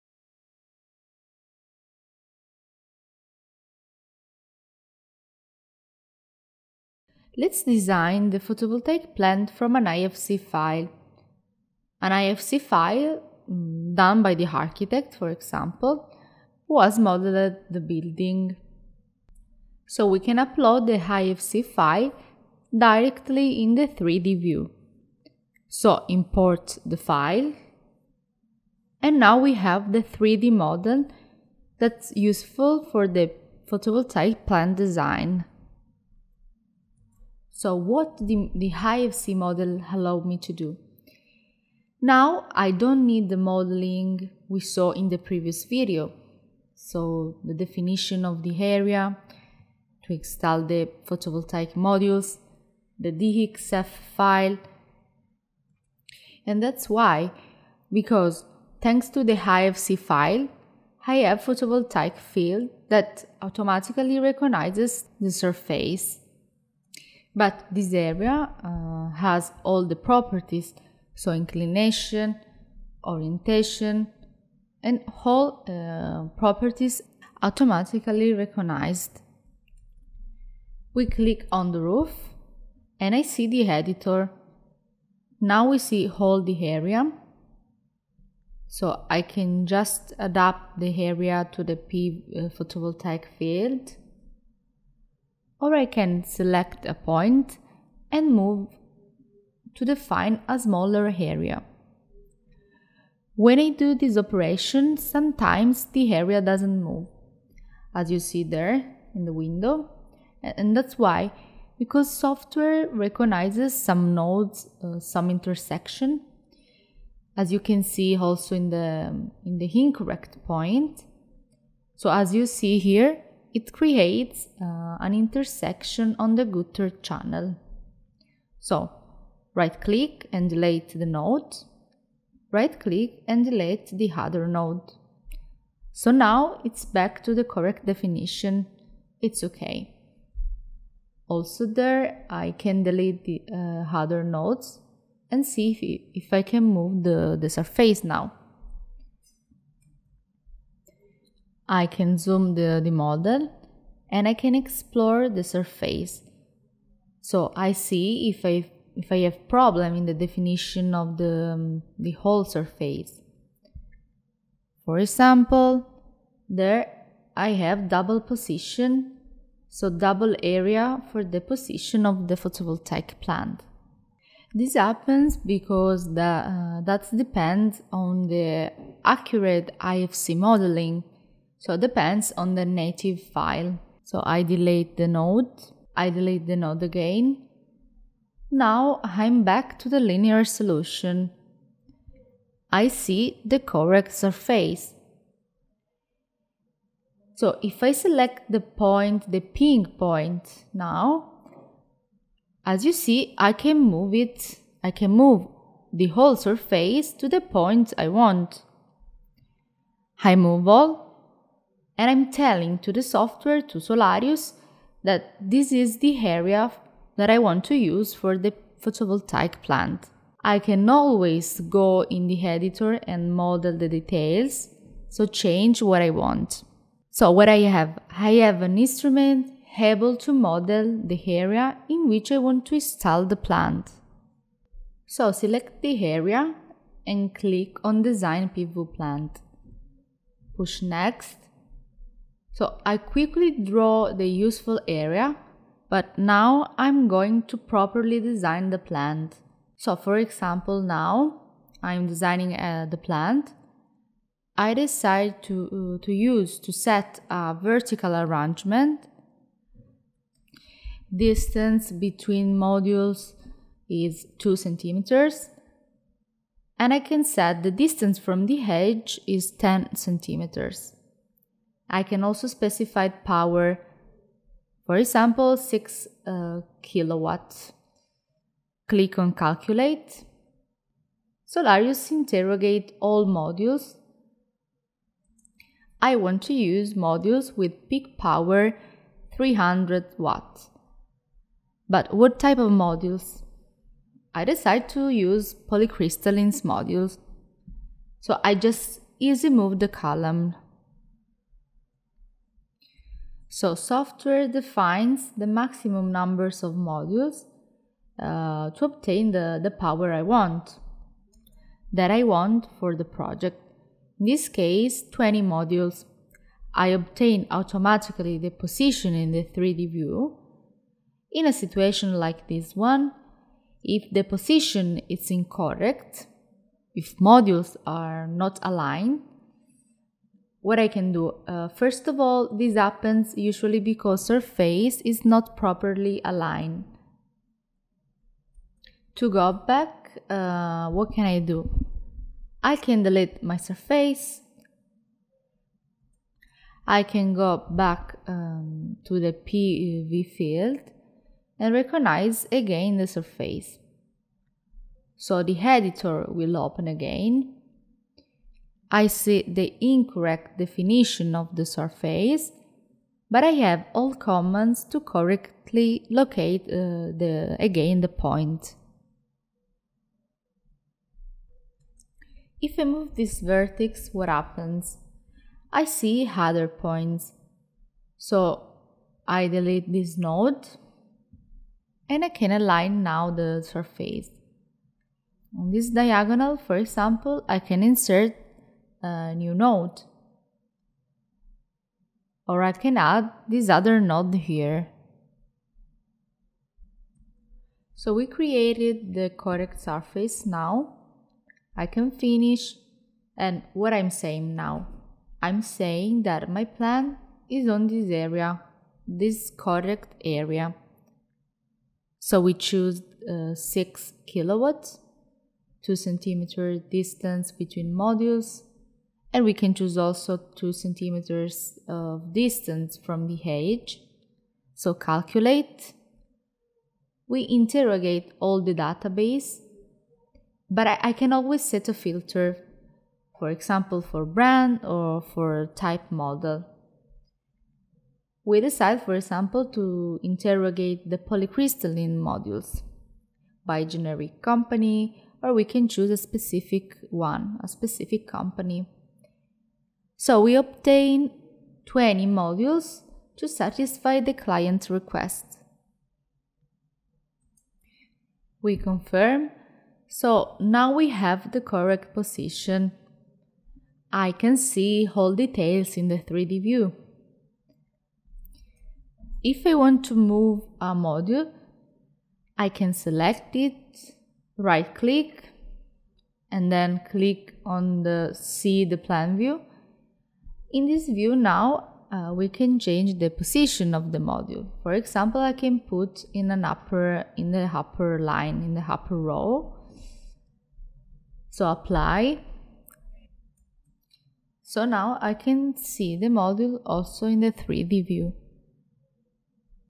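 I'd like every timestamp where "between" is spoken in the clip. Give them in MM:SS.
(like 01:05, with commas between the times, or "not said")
04:21, 06:57.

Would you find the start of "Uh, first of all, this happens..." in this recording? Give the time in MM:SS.
05:31.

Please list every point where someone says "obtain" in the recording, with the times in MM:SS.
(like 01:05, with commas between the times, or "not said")
05:08, 05:16, 07:30.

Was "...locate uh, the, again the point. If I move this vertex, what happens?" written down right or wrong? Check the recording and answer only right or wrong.
right.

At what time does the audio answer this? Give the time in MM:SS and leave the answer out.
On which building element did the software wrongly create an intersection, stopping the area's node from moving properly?
02:06.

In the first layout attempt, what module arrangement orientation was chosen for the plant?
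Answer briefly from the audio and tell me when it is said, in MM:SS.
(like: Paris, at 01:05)
vertical, at 04:17.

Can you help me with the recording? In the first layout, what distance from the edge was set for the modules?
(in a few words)
10 centimeters.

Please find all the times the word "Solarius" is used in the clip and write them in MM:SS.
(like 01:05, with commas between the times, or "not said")
03:33, 04:41.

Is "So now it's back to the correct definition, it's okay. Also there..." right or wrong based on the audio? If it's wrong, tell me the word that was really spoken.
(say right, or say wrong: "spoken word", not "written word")
right.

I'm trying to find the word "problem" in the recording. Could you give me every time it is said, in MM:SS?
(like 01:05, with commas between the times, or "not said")
02:39.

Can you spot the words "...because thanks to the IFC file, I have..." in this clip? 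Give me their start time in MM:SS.
00:57.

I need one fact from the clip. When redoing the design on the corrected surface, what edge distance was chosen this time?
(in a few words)
2 centimeters.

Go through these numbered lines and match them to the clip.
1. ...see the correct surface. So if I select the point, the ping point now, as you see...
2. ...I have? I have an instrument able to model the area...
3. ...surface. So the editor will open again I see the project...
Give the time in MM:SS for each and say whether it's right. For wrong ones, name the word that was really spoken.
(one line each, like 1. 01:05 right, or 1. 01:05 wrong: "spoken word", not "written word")
1. 03:12 right
2. 03:47 right
3. 05:53 wrong: "incorrect", not "project".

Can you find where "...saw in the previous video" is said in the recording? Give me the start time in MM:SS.
00:44.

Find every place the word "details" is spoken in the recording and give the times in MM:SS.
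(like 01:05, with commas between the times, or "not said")
03:43, 07:45.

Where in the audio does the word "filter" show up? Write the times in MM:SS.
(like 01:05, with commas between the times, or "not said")
07:11.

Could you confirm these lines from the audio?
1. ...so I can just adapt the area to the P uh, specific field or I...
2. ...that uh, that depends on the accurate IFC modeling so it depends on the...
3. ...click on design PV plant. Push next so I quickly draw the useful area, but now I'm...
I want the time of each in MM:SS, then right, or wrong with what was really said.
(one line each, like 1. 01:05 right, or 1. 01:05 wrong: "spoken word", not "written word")
1. 01:28 wrong: "photovoltaic", not "specific"
2. 02:56 right
3. 03:57 right.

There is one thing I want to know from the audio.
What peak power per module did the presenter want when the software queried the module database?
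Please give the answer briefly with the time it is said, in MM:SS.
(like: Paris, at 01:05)
300 watts, at 04:49.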